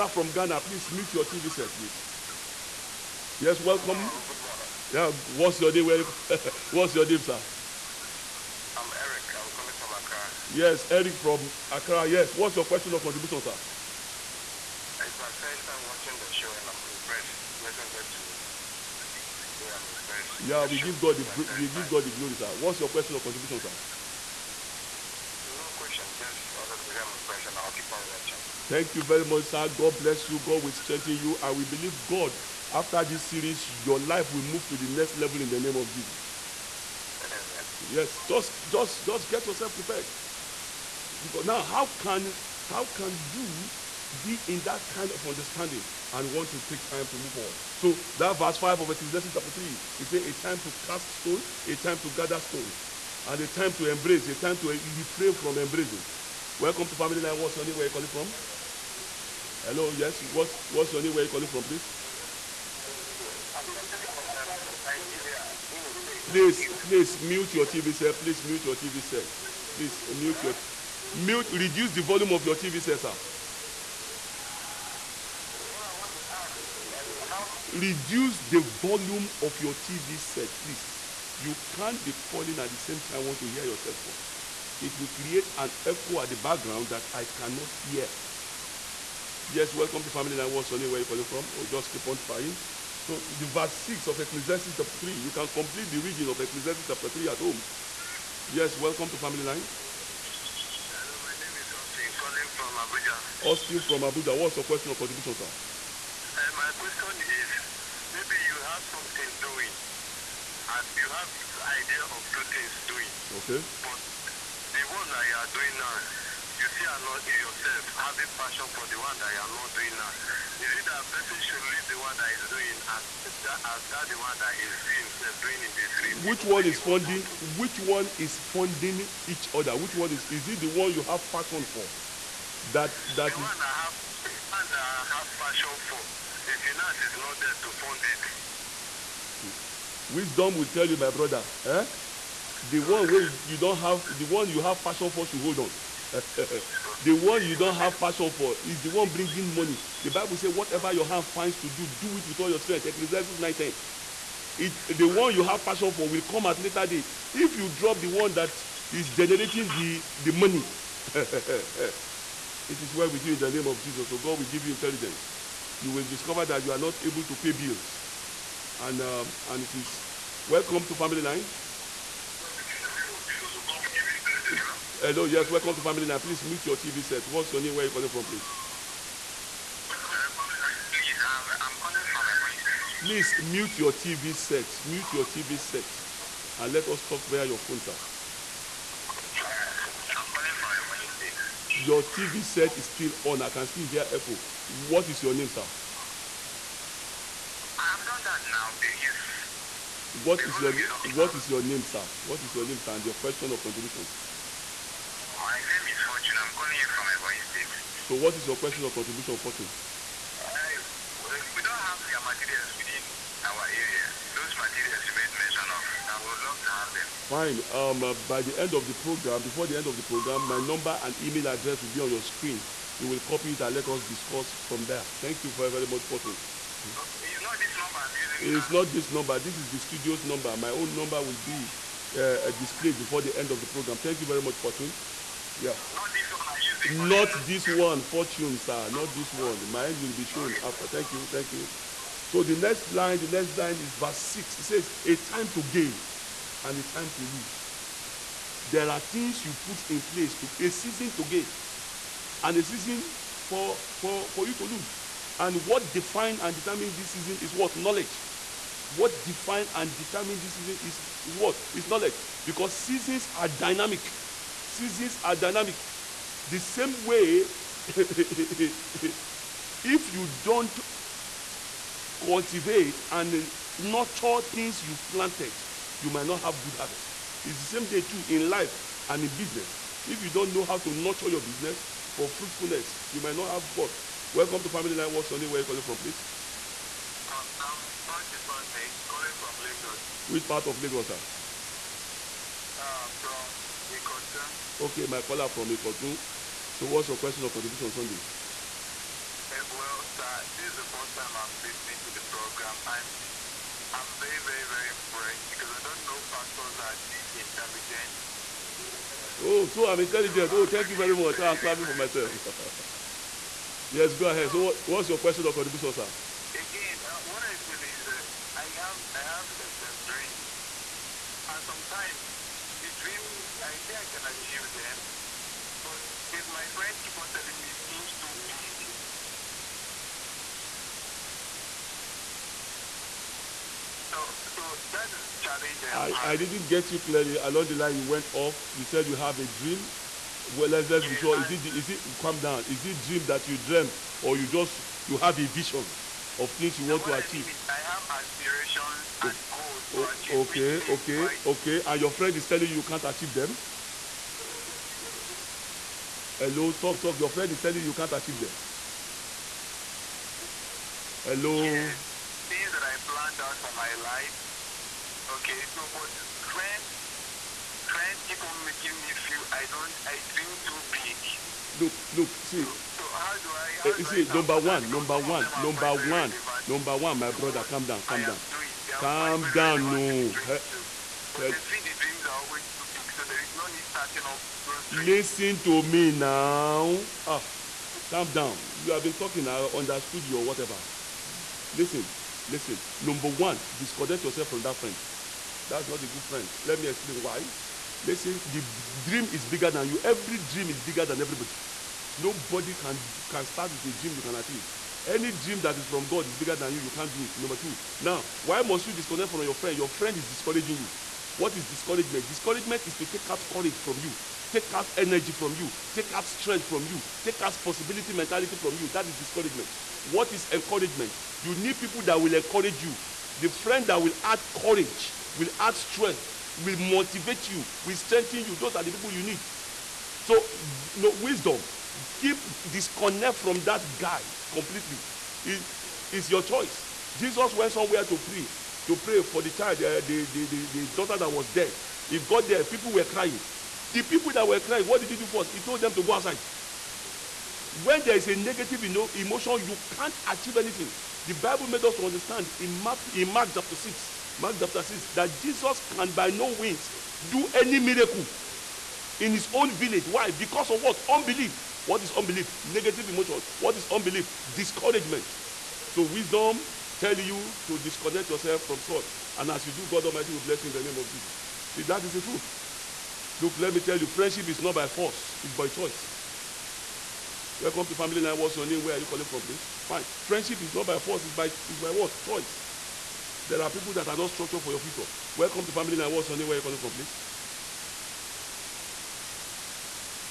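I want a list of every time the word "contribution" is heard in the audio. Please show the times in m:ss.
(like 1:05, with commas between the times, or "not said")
0:12, 0:23, 1:44, 3:23, 3:28, 4:57, 5:15.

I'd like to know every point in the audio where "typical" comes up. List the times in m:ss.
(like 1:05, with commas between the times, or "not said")
not said.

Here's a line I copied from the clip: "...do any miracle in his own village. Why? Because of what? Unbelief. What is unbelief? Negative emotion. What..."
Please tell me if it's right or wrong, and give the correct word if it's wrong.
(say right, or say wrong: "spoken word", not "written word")
right.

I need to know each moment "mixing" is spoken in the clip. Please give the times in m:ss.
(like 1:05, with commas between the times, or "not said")
not said.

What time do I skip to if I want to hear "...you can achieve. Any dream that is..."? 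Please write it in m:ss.
6:44.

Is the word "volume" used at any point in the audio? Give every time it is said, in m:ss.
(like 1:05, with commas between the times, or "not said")
1:12, 1:18.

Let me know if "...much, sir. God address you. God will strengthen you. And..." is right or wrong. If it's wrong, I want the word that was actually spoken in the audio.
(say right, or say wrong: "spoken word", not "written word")
wrong: "bless", not "address".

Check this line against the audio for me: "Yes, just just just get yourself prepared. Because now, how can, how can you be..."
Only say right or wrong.
right.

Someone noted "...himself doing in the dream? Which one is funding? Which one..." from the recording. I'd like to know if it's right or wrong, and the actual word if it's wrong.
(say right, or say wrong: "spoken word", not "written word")
right.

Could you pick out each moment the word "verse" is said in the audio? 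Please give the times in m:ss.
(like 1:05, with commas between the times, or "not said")
0:48, 1:33, 4:03.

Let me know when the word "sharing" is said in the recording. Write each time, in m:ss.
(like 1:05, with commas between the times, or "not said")
not said.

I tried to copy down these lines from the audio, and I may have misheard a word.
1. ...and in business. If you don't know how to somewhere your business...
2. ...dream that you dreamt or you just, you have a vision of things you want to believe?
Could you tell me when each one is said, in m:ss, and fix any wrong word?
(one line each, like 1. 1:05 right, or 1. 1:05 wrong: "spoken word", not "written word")
1. 4:39 wrong: "nurture", not "somewhere"
2. 5:42 wrong: "achieve", not "believe".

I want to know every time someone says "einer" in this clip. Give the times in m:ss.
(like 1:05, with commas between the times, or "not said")
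not said.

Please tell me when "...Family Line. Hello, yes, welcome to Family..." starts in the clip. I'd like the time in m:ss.
2:50.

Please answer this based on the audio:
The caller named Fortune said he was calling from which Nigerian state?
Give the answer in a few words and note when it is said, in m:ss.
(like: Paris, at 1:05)
Ebonyi State, at 3:27.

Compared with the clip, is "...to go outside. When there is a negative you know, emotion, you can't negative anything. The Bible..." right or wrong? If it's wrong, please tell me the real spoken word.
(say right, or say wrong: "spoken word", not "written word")
wrong: "achieve", not "negative".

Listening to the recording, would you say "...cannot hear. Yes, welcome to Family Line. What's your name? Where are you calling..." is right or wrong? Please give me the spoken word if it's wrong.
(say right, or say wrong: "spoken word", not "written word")
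right.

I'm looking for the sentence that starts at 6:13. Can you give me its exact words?
How uh, do see, I number one, number one, number one, number one, my brother, calm down, calm down, calm down, no.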